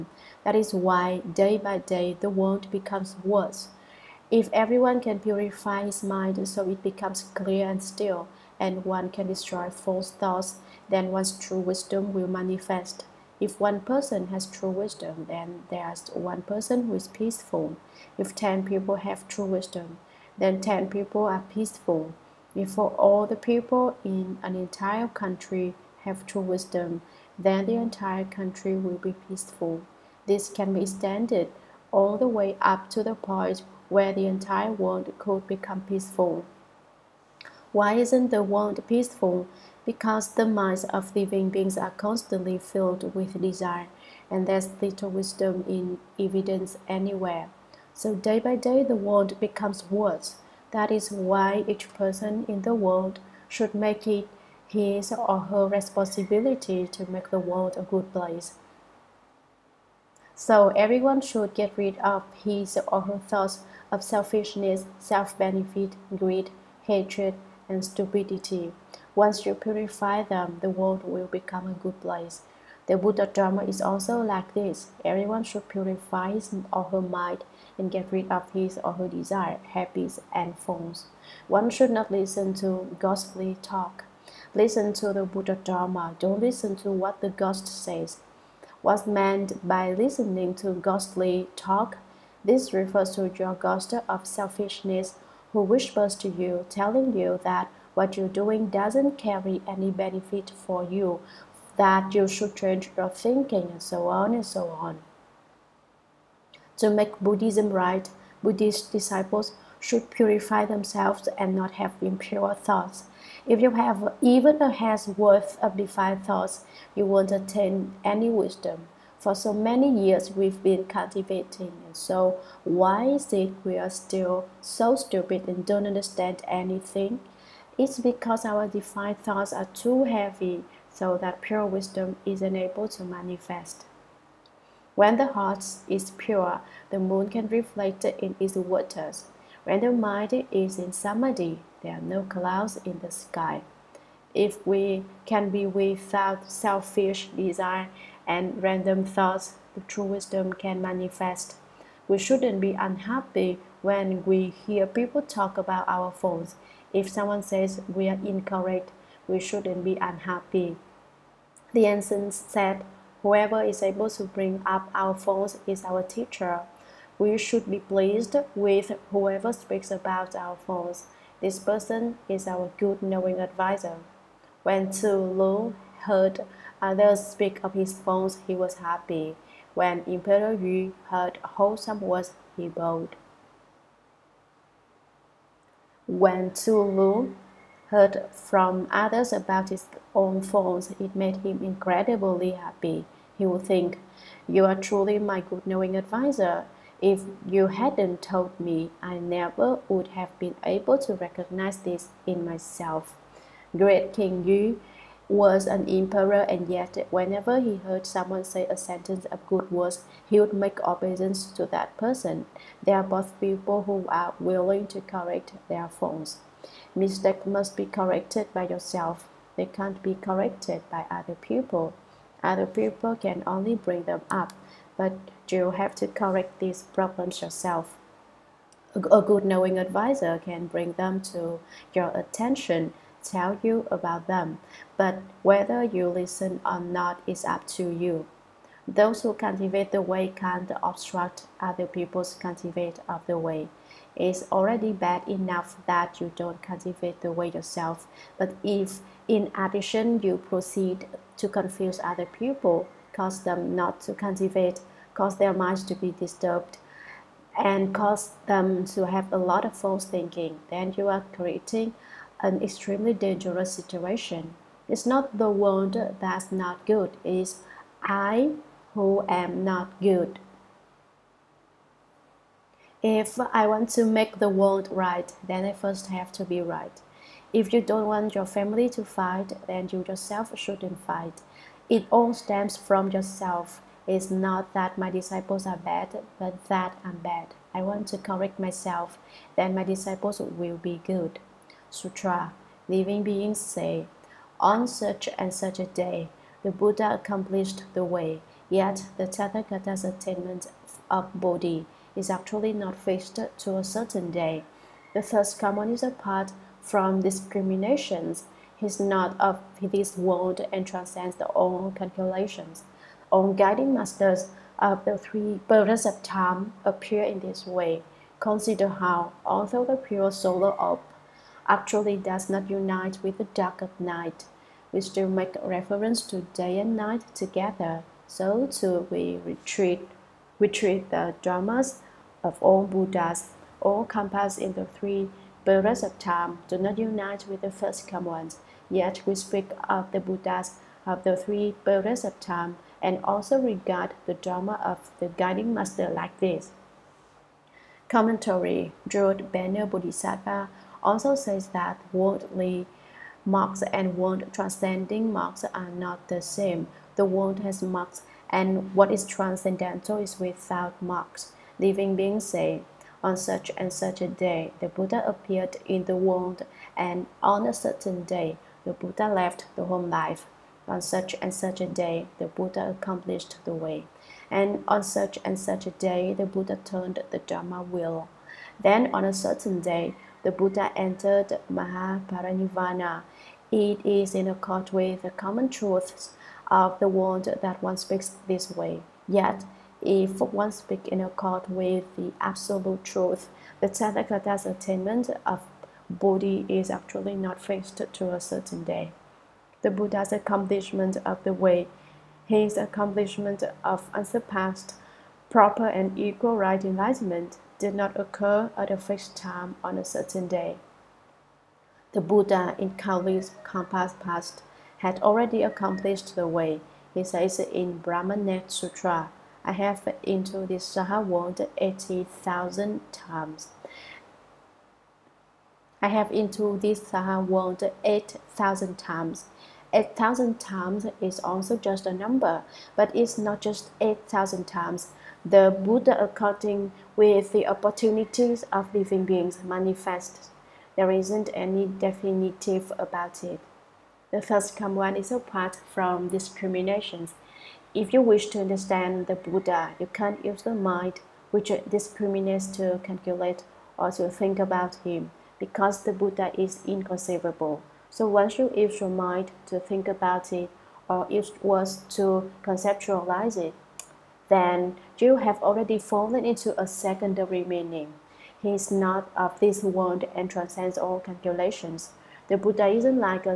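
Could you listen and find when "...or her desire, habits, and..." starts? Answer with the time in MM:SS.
01:18.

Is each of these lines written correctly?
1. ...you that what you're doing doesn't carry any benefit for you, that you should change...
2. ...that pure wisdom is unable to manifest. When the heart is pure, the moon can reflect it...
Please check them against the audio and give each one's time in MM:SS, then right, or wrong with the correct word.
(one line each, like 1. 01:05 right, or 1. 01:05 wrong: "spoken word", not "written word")
1. 01:37 right
2. 02:11 right.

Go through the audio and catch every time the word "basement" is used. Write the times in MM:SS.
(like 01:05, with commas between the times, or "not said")
not said.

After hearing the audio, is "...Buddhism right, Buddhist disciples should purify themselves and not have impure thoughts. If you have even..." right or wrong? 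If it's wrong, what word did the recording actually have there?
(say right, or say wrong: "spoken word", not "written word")
right.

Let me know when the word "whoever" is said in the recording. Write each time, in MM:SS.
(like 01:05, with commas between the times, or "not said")
02:43, 02:49.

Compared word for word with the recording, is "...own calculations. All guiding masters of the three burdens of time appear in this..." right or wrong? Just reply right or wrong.
right.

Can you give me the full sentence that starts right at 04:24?
It's not the world that's not good, it's I who am not good.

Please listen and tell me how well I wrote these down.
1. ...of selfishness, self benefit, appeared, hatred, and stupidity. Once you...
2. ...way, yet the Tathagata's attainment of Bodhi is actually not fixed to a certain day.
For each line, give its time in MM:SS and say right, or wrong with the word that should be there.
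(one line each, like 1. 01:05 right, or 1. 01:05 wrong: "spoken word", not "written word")
1. 01:03 wrong: "greed", not "appeared"
2. 04:58 right.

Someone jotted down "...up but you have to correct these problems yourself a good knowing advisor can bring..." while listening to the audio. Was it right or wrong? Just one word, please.
right.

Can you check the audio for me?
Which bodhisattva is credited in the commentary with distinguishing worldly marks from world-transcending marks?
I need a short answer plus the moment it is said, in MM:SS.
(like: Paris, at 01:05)
Jeweled Banner Bodhisattva, at 05:49.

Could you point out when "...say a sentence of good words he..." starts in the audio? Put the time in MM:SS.
03:28.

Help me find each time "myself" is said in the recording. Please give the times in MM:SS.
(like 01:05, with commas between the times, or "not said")
03:22, 04:48.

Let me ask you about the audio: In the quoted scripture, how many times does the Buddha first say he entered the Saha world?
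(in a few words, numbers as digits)
80,000.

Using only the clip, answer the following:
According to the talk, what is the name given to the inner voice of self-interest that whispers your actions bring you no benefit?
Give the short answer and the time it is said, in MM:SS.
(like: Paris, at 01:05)
ghost of selfishness, at 01:33.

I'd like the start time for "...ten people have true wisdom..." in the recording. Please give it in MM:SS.
00:18.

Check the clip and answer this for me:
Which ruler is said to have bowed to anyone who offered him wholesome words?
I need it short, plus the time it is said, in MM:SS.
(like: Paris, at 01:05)
Emperor Yu, at 03:00.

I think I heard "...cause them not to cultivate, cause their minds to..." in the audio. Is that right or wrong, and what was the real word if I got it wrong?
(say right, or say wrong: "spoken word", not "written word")
right.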